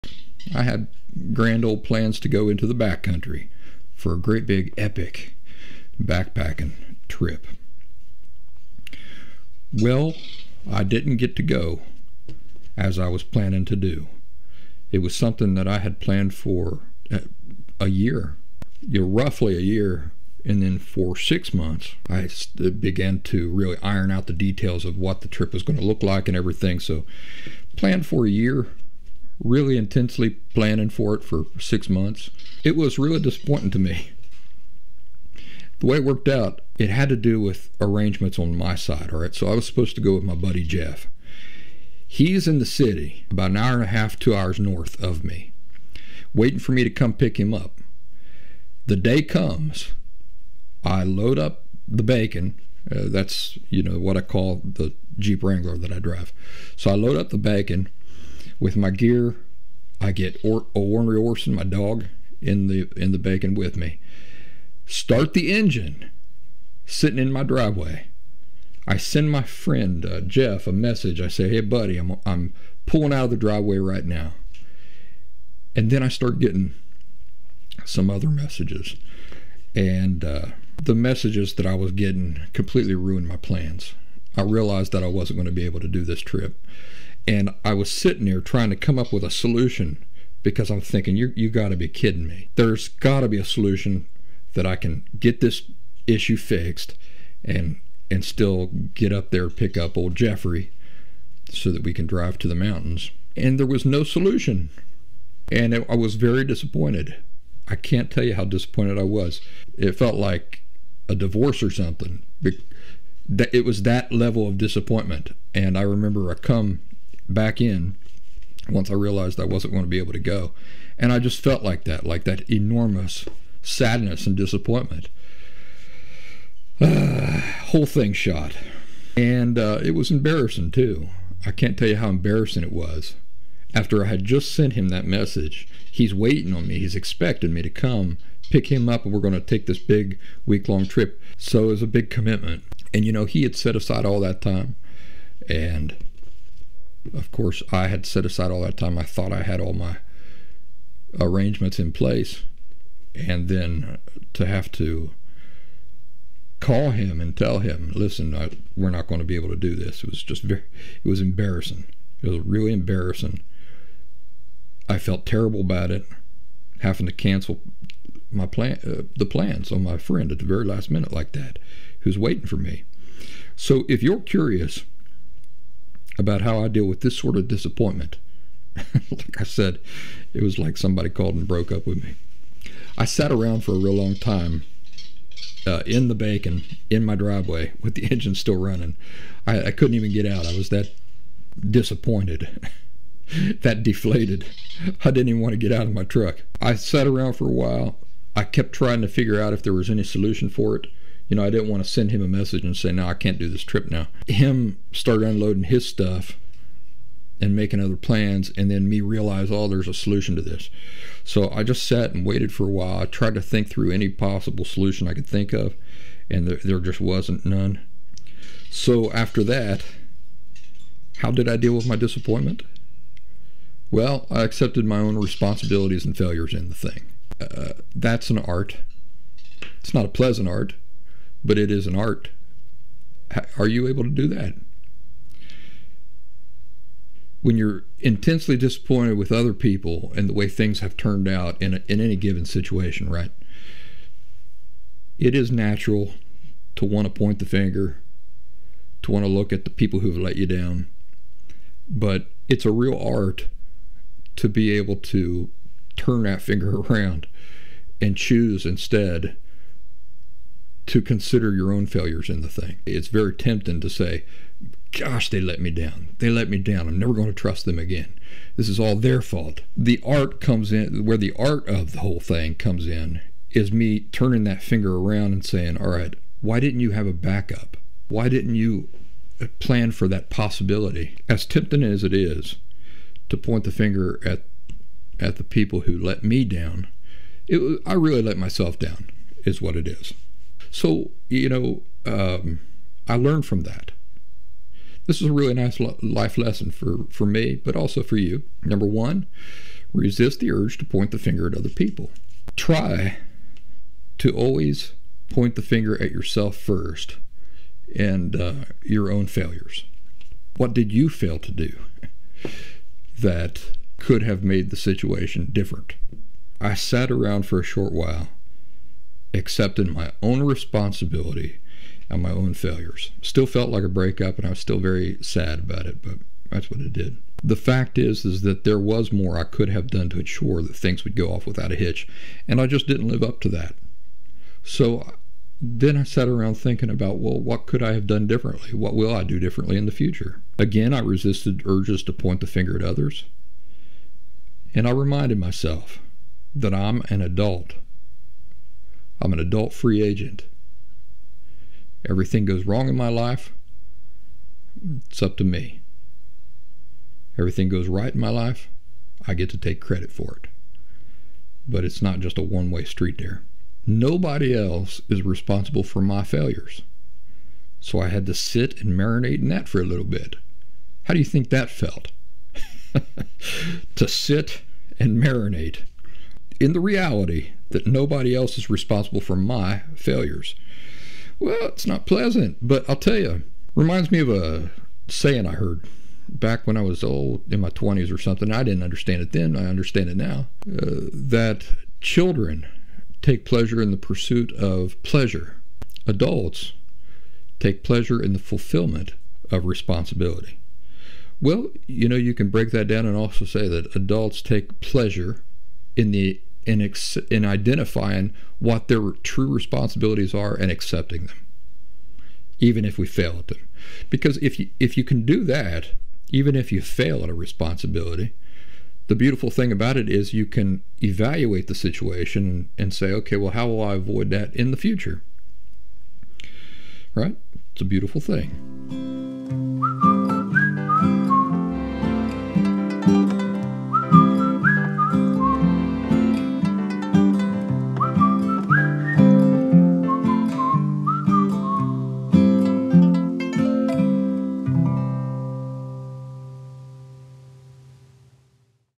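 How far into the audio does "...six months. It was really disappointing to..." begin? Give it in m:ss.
0:31.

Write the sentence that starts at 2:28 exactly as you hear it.
I thought I had all my arrangements in place.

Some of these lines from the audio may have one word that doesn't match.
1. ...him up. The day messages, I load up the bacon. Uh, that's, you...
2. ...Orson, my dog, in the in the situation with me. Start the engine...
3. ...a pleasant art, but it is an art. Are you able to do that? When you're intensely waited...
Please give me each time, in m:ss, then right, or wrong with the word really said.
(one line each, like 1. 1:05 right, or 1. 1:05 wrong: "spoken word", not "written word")
1. 0:47 wrong: "comes", not "messages"
2. 1:01 wrong: "bacon", not "situation"
3. 3:50 wrong: "disappointed", not "waited".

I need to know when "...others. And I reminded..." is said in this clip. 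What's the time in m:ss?
5:42.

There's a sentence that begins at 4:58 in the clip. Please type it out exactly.
Number one, resist the urge to point the finger at other people.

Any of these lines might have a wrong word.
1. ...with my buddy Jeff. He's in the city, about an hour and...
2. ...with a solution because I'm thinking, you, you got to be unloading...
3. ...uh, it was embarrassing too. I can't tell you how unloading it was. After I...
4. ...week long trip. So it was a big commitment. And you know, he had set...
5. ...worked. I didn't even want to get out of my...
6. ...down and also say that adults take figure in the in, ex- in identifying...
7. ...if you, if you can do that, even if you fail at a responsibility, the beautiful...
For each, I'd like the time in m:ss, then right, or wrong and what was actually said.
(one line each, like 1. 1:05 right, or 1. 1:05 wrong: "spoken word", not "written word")
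1. 0:40 right
2. 1:29 wrong: "kidding", not "unloading"
3. 2:09 wrong: "embarrassing", not "unloading"
4. 2:20 right
5. 3:13 wrong: "deflated", not "worked"
6. 6:42 wrong: "pleasure", not "figure"
7. 6:54 right.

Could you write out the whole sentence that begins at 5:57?
Everything goes right in my life, I get to take credit for it.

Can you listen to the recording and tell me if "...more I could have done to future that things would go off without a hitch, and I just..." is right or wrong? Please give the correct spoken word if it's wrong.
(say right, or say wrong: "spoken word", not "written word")
wrong: "ensure", not "future".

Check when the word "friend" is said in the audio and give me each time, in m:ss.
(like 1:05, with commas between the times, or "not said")
1:09, 2:49.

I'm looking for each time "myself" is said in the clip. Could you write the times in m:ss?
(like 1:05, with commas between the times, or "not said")
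4:48, 5:45.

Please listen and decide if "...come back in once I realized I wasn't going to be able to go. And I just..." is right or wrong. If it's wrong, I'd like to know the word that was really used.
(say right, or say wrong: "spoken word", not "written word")
right.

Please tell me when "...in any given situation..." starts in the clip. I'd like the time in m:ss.
4:01.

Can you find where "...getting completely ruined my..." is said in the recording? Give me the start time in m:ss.
1:21.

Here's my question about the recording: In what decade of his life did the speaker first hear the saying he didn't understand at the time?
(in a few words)
His 20s.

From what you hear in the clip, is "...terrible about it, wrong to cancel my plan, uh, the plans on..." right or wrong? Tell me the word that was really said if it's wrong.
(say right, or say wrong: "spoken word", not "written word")
wrong: "having", not "wrong".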